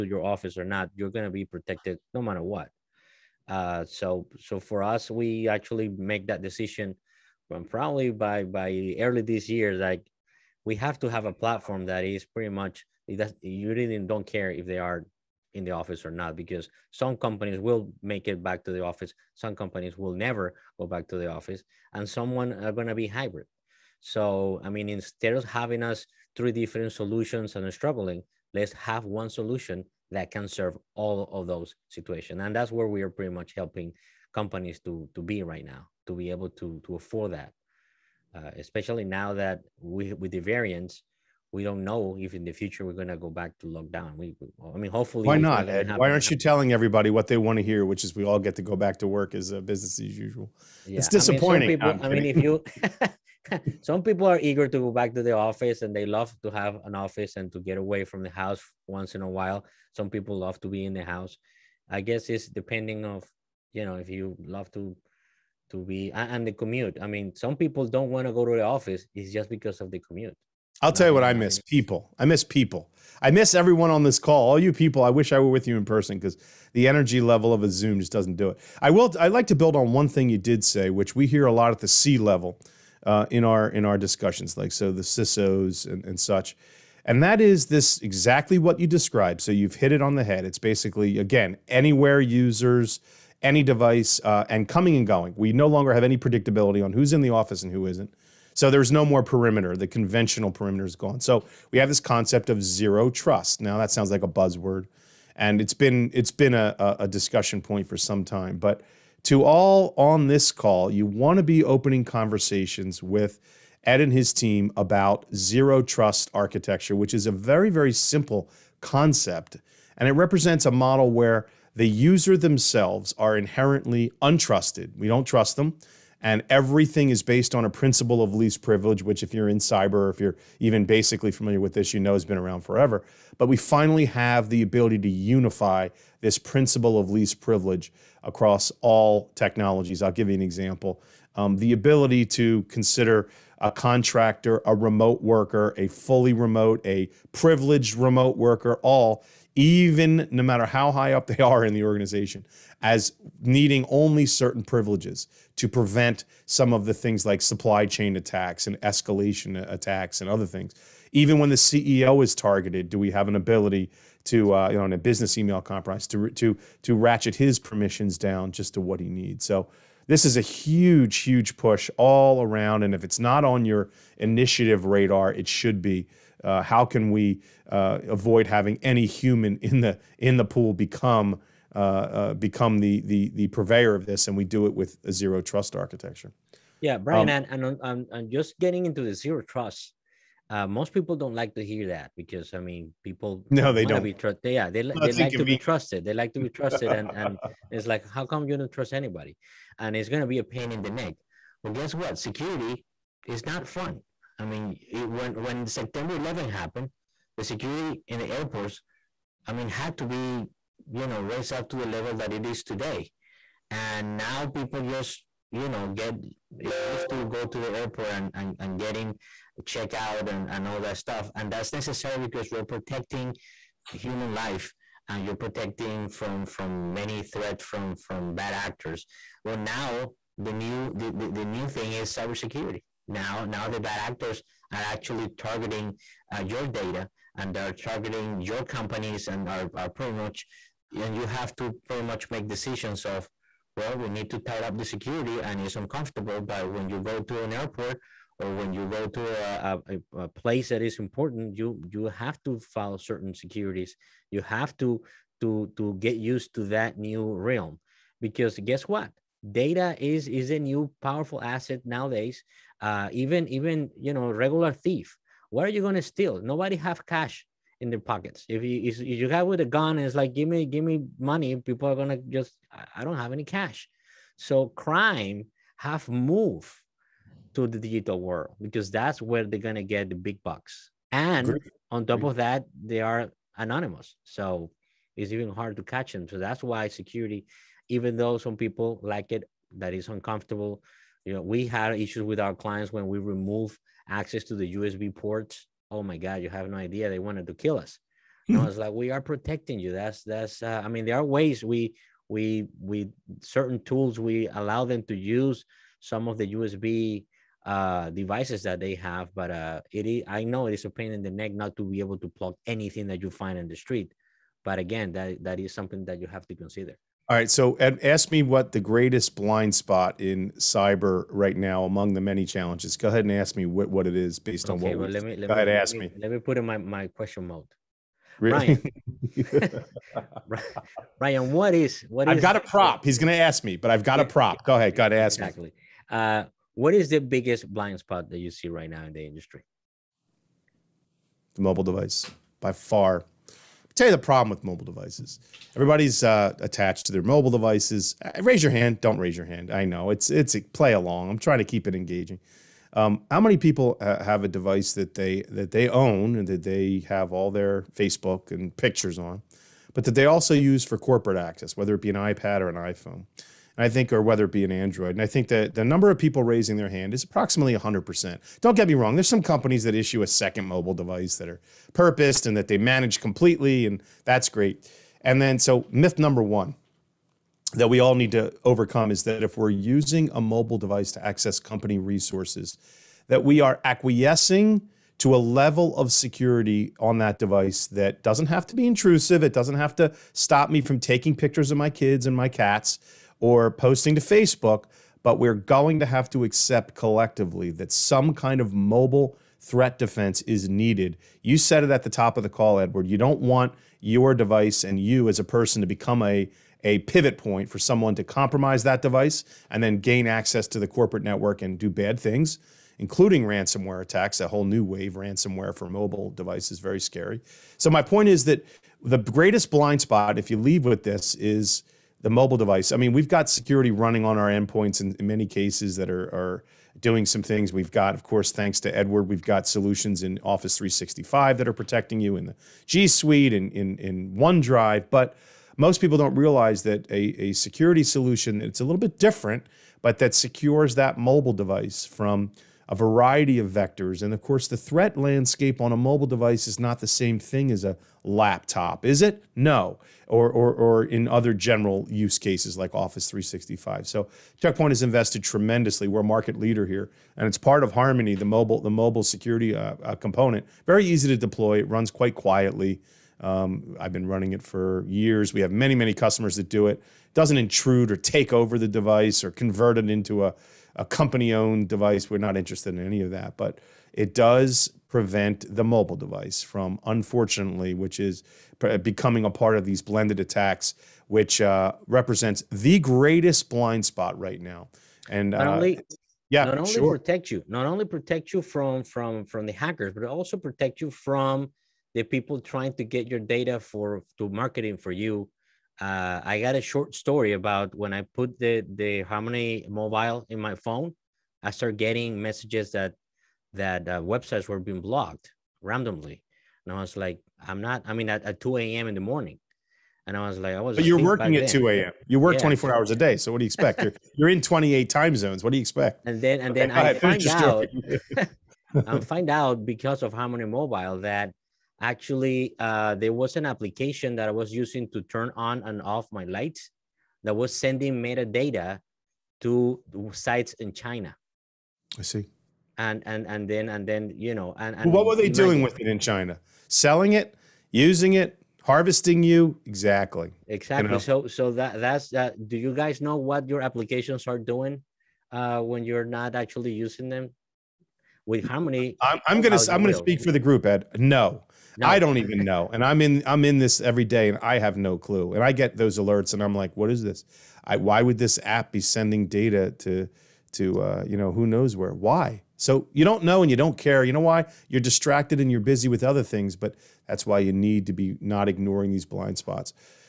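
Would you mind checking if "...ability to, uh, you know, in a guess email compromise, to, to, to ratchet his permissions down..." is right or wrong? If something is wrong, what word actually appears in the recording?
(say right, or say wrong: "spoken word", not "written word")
wrong: "business", not "guess".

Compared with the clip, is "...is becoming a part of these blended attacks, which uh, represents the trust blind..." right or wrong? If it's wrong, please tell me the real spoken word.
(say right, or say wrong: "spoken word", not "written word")
wrong: "greatest", not "trust".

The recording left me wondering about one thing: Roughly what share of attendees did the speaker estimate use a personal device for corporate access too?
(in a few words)
100%.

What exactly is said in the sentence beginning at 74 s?
All you people, I wish I were with you in person because the energy level of a Zoom just doesn't do it.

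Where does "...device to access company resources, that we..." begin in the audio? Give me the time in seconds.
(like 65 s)
380 s.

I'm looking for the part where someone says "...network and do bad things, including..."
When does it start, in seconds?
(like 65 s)
411 s.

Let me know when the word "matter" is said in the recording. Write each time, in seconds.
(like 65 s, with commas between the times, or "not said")
2 s, 150 s.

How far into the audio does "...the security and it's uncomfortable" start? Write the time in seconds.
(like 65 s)
244 s.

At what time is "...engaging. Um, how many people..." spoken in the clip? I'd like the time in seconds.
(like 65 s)
351 s.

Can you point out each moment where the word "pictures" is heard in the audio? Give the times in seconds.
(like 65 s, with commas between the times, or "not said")
358 s, 391 s.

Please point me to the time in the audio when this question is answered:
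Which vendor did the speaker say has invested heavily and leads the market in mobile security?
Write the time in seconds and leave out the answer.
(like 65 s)
454 s.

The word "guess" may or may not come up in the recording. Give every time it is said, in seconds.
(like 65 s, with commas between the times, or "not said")
62 s, 201 s, 258 s.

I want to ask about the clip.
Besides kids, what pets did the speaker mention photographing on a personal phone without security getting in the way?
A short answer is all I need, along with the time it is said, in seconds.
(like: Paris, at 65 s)
cats, at 392 s.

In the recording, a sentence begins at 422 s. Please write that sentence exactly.
I mean, we've got security running on our endpoints in, in many cases that are, are doing some things.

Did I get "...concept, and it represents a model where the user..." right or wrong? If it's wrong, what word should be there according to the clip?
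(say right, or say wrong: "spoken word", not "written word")
right.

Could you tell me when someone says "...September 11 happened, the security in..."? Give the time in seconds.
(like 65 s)
205 s.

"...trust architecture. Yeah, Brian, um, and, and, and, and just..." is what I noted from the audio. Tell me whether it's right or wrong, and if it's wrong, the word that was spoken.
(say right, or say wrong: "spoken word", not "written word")
right.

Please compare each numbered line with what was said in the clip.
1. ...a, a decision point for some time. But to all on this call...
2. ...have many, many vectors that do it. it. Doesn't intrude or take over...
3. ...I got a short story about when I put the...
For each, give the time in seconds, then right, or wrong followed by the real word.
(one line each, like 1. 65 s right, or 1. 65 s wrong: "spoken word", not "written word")
1. 106 s wrong: "discussion", not "decision"
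2. 465 s wrong: "customers", not "vectors"
3. 496 s right.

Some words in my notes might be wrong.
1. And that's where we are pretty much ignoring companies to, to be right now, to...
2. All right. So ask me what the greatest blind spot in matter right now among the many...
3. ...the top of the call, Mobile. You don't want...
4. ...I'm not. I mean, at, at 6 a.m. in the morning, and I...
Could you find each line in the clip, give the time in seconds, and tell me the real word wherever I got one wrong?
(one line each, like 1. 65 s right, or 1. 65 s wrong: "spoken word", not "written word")
1. 32 s wrong: "helping", not "ignoring"
2. 317 s wrong: "cyber", not "matter"
3. 402 s wrong: "Eduard", not "Mobile"
4. 507 s wrong: "2", not "6".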